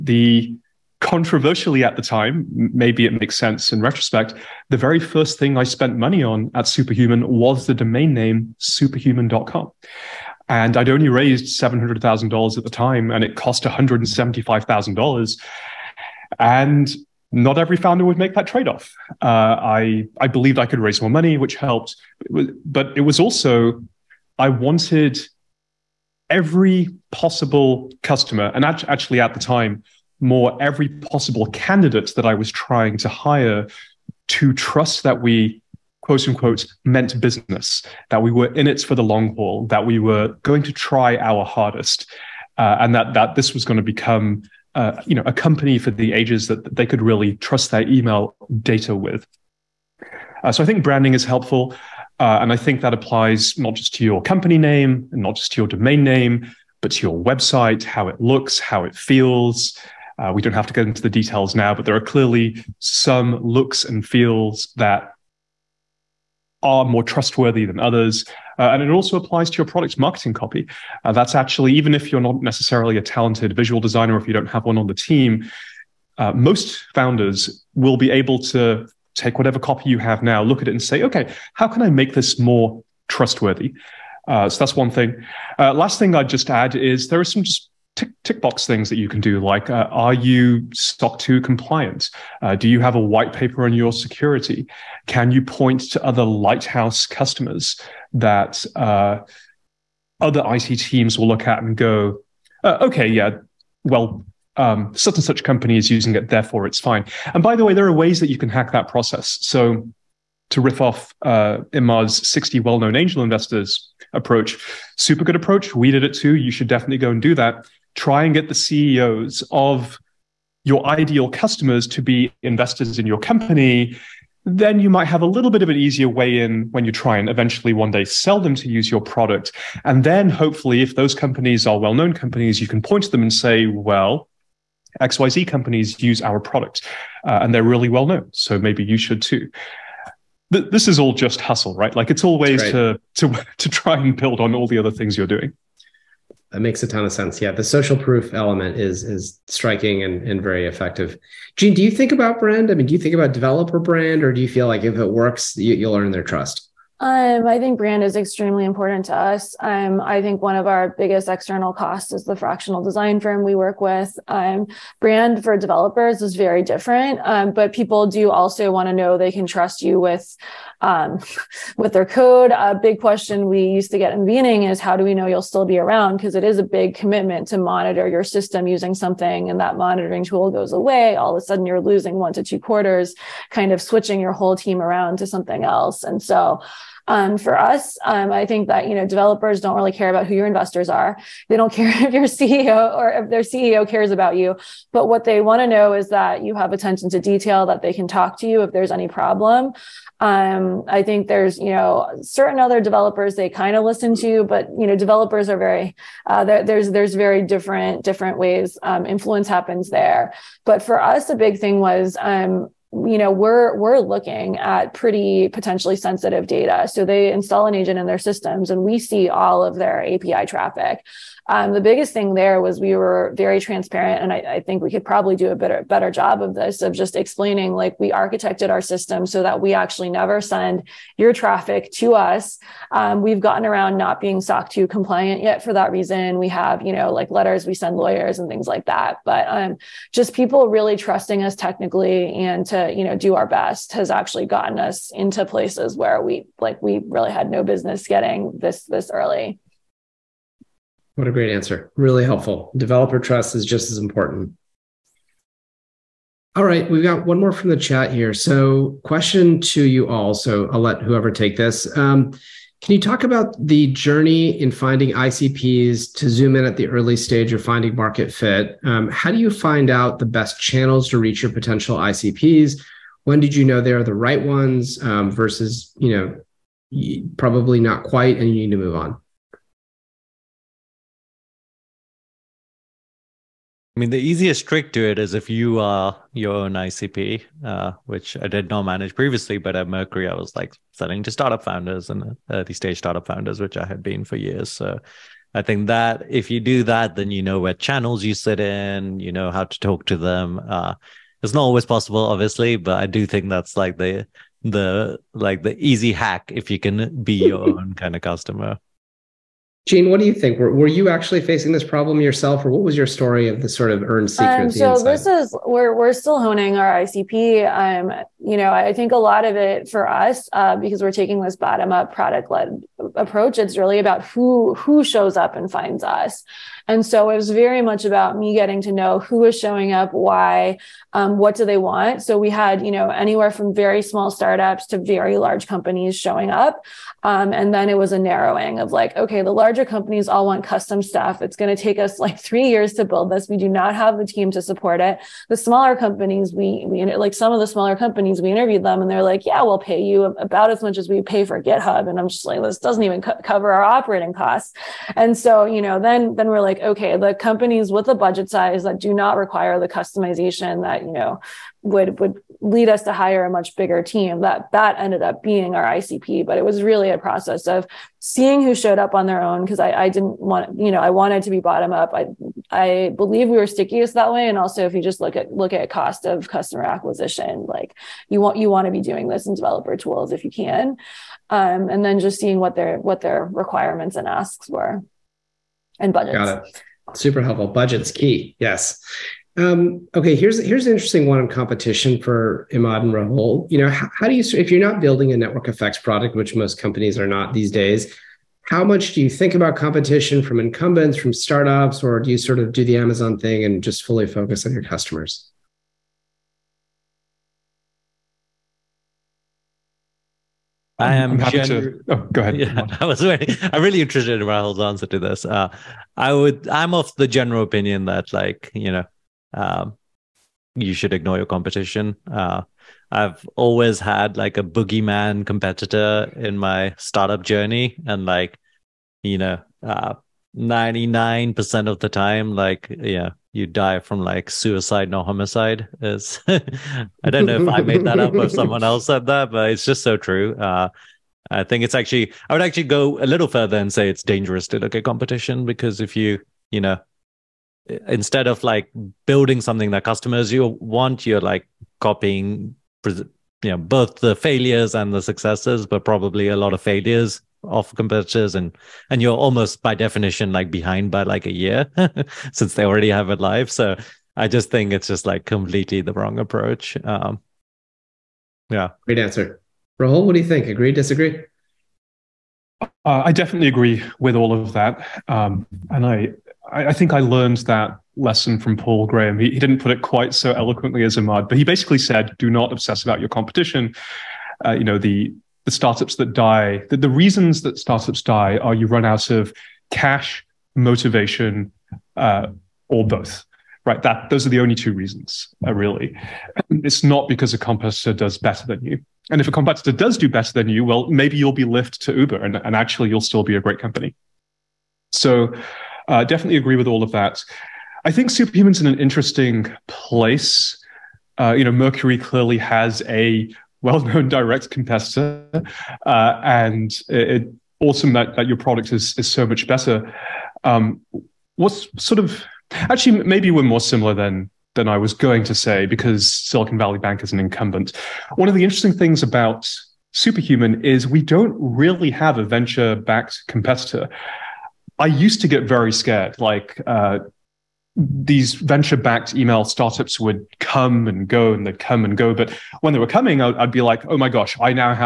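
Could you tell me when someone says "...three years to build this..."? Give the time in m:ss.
5:42.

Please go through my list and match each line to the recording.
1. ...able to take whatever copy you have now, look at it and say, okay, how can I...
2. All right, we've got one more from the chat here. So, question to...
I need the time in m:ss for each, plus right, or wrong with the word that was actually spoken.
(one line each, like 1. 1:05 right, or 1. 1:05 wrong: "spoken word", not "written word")
1. 1:18 right
2. 4:16 right.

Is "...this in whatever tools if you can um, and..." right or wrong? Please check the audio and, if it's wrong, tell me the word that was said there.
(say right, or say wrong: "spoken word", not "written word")
wrong: "developer", not "whatever".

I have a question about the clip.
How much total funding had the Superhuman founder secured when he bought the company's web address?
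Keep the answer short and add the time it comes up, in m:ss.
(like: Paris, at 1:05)
$700,000, at 0:11.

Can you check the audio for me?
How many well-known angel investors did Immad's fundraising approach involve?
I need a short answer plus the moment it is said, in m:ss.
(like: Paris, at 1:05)
60, at 1:52.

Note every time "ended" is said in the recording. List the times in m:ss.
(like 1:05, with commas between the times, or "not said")
6:04.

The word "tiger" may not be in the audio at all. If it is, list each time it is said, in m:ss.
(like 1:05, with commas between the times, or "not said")
not said.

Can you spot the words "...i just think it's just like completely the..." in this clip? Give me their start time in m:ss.
7:44.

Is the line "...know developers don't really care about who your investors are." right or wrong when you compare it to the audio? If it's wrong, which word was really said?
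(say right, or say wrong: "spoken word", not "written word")
right.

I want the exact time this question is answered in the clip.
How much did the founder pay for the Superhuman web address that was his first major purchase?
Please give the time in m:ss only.
0:13.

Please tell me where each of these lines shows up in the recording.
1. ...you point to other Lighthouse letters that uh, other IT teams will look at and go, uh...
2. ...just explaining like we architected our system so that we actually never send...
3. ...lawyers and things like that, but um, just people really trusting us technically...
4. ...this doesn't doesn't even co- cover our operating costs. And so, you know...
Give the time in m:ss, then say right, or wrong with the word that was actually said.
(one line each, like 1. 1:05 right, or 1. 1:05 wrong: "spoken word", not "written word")
1. 1:35 wrong: "customers", not "letters"
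2. 3:46 right
3. 3:57 right
4. 5:52 right.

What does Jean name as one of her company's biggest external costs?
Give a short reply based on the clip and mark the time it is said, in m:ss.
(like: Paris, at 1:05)
fractional design firm, at 2:42.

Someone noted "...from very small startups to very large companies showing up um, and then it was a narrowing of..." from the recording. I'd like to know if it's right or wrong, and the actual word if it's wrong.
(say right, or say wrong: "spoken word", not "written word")
right.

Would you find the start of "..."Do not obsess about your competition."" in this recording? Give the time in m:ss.
8:02.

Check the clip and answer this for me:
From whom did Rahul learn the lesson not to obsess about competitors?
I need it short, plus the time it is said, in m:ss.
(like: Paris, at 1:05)
Paul Graham, at 7:58.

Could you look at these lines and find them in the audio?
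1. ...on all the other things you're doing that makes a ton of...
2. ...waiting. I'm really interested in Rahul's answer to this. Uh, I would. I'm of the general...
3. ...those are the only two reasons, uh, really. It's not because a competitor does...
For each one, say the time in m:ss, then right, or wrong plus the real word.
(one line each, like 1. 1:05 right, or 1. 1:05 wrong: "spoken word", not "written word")
1. 2:24 right
2. 6:53 right
3. 8:14 right.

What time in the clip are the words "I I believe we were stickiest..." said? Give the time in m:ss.
6:12.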